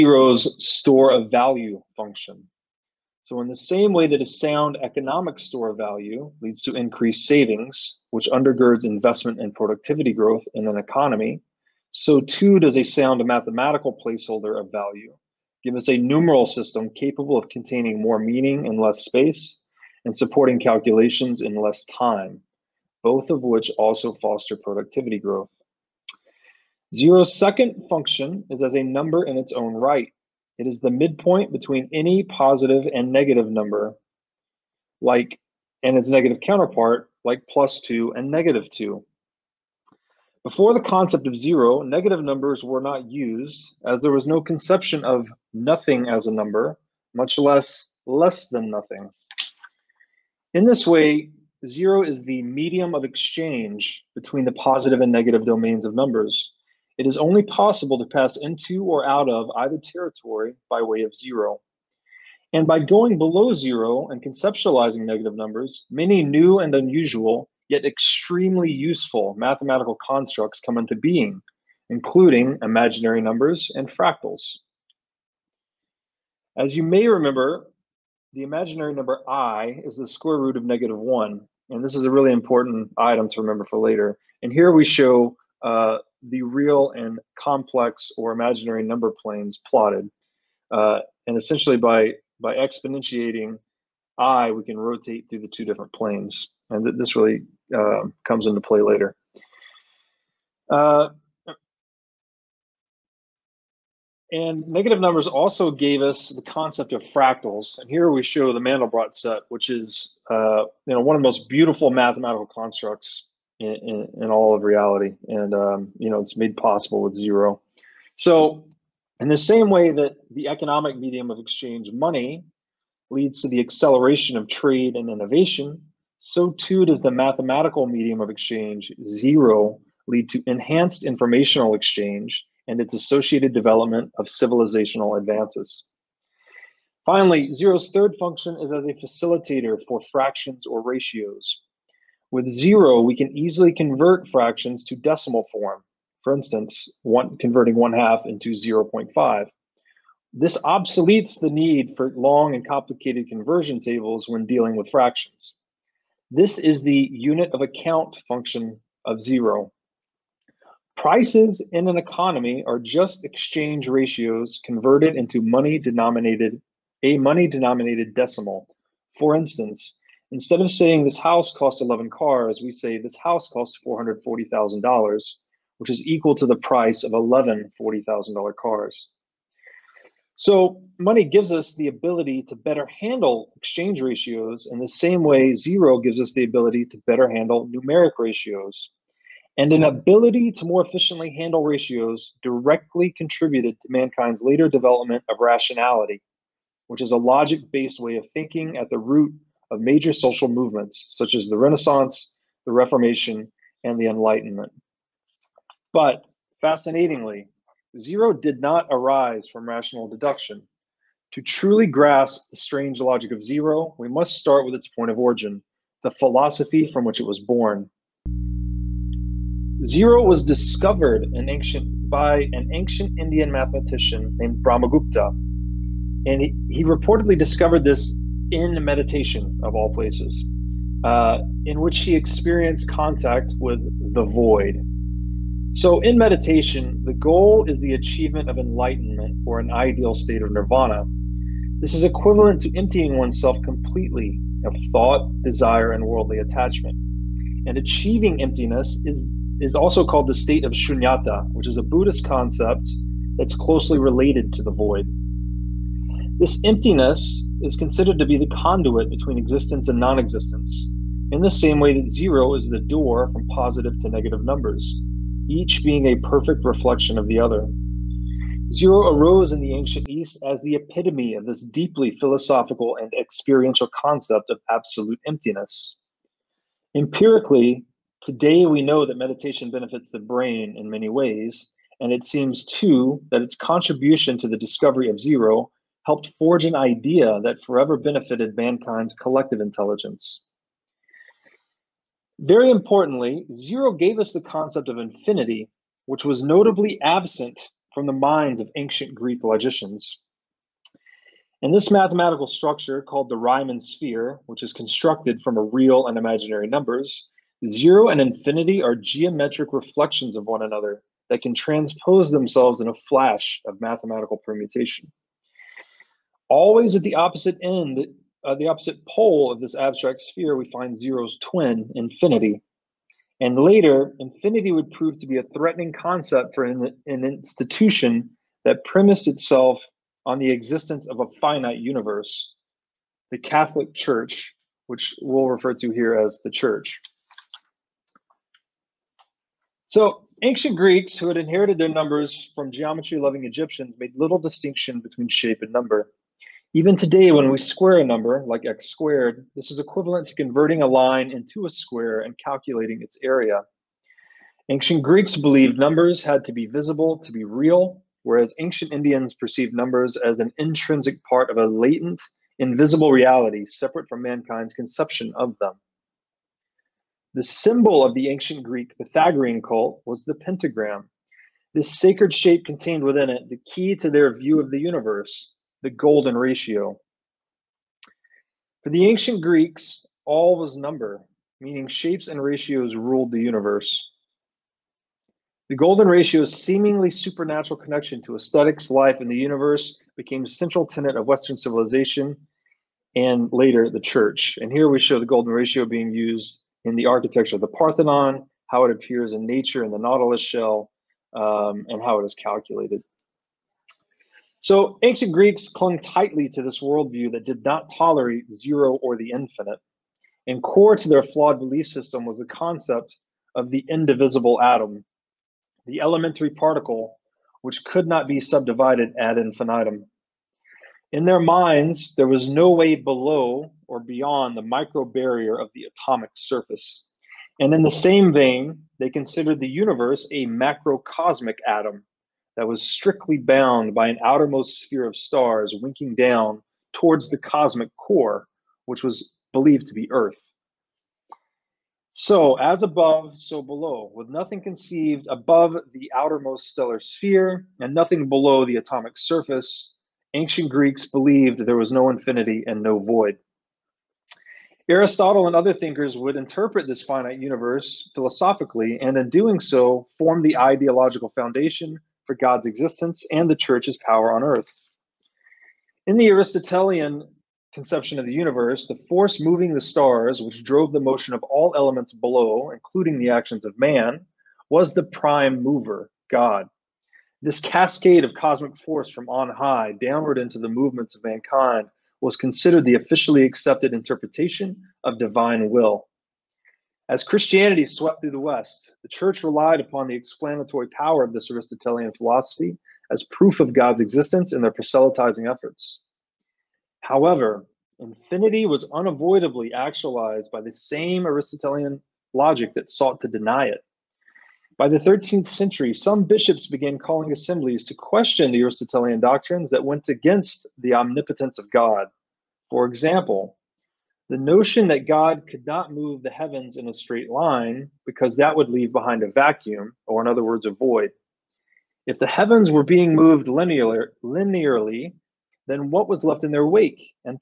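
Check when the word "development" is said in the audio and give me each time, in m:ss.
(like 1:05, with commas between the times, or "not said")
2:13, 3:14.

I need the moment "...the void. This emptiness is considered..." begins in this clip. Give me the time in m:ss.
4:14.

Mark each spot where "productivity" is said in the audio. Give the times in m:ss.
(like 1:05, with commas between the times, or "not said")
0:09, 0:24.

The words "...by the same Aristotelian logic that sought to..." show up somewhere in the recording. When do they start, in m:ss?
8:20.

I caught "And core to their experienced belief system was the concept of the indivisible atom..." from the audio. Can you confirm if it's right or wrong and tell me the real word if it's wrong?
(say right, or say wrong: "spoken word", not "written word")
wrong: "flawed", not "experienced".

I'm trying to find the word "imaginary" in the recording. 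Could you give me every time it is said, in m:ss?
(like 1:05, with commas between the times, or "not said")
1:12, 1:18, 1:28, 5:06.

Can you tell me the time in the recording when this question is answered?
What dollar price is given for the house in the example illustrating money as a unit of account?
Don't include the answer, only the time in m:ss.
2:53.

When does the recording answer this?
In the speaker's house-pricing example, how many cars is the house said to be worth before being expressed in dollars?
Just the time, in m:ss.
2:51.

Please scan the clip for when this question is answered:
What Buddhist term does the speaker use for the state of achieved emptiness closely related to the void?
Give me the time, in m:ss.
4:10.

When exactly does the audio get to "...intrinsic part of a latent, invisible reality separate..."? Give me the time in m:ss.
6:00.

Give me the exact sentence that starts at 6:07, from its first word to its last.
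The symbol of the ancient Greek Pythagorean cult was the pentagram.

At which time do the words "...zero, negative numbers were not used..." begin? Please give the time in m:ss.
0:41.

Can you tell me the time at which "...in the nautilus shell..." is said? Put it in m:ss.
6:39.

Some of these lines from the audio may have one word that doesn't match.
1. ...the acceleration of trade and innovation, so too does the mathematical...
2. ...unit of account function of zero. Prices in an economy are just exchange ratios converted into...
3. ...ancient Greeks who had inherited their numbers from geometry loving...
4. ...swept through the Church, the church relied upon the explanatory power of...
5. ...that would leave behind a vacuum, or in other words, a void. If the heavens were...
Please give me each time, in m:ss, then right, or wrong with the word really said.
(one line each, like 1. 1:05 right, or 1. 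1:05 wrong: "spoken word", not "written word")
1. 2:03 right
2. 2:37 right
3. 5:40 right
4. 8:07 wrong: "West", not "Church"
5. 8:38 right.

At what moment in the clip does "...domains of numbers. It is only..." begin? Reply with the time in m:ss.
0:55.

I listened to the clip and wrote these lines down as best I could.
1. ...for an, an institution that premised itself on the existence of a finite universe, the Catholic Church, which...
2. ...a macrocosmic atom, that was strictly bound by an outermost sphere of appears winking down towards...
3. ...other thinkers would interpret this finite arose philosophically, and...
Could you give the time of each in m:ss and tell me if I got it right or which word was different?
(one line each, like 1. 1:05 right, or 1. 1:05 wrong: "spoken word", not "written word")
1. 5:26 right
2. 7:10 wrong: "stars", not "appears"
3. 7:35 wrong: "universe", not "arose".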